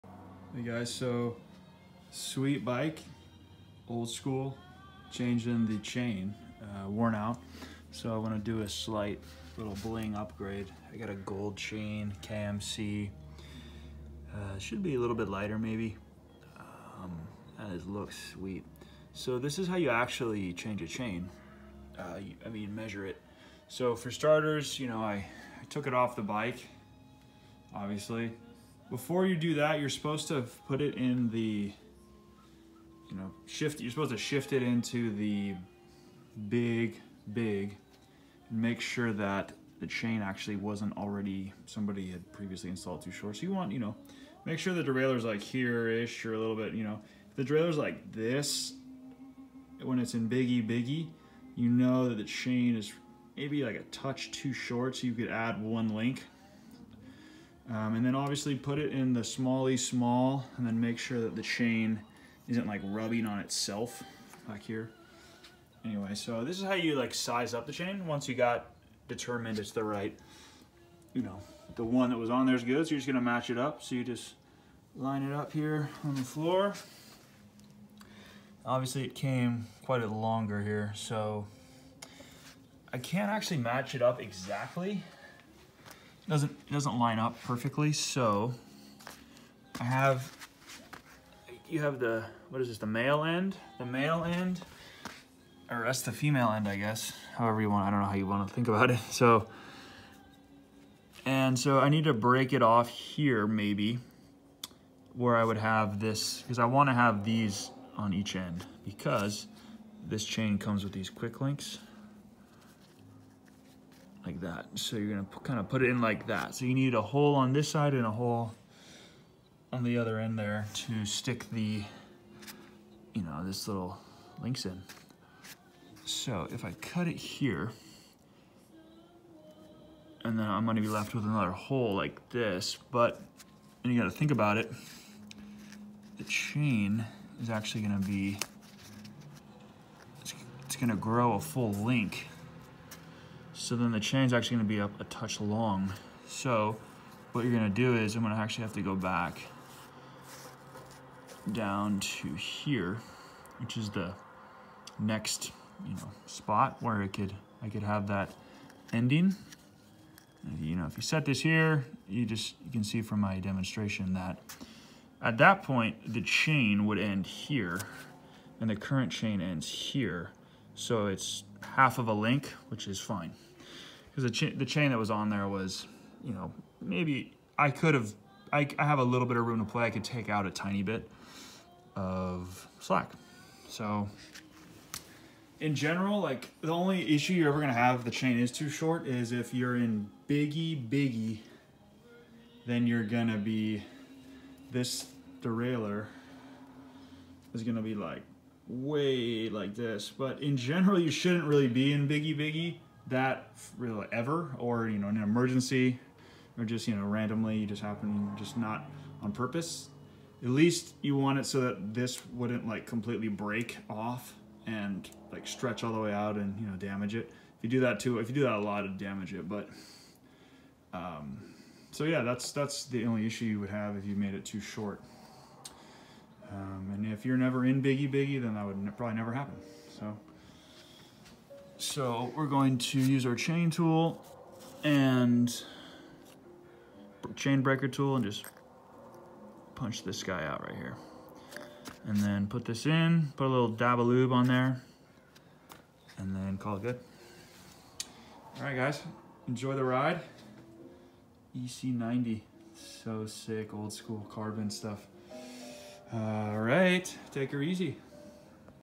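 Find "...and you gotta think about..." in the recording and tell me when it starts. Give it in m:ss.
2:13.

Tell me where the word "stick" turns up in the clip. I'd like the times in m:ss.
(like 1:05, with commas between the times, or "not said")
2:01.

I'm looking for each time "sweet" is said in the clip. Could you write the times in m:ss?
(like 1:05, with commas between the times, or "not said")
0:02, 0:18.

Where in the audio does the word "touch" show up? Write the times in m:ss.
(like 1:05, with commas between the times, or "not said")
0:53, 2:25.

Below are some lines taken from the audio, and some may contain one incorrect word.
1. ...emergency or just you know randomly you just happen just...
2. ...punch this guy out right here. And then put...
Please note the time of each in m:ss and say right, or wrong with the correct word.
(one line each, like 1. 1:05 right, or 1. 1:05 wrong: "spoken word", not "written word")
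1. 3:25 right
2. 3:59 right.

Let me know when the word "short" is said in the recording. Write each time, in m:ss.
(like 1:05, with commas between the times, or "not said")
0:43, 0:54, 3:08, 3:44.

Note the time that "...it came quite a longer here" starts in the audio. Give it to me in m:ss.
1:19.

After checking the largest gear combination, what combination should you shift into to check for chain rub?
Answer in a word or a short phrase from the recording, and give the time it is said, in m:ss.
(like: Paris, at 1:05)
smally small, at 0:59.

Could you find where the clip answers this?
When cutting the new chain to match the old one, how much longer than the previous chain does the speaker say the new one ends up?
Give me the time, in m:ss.
2:51.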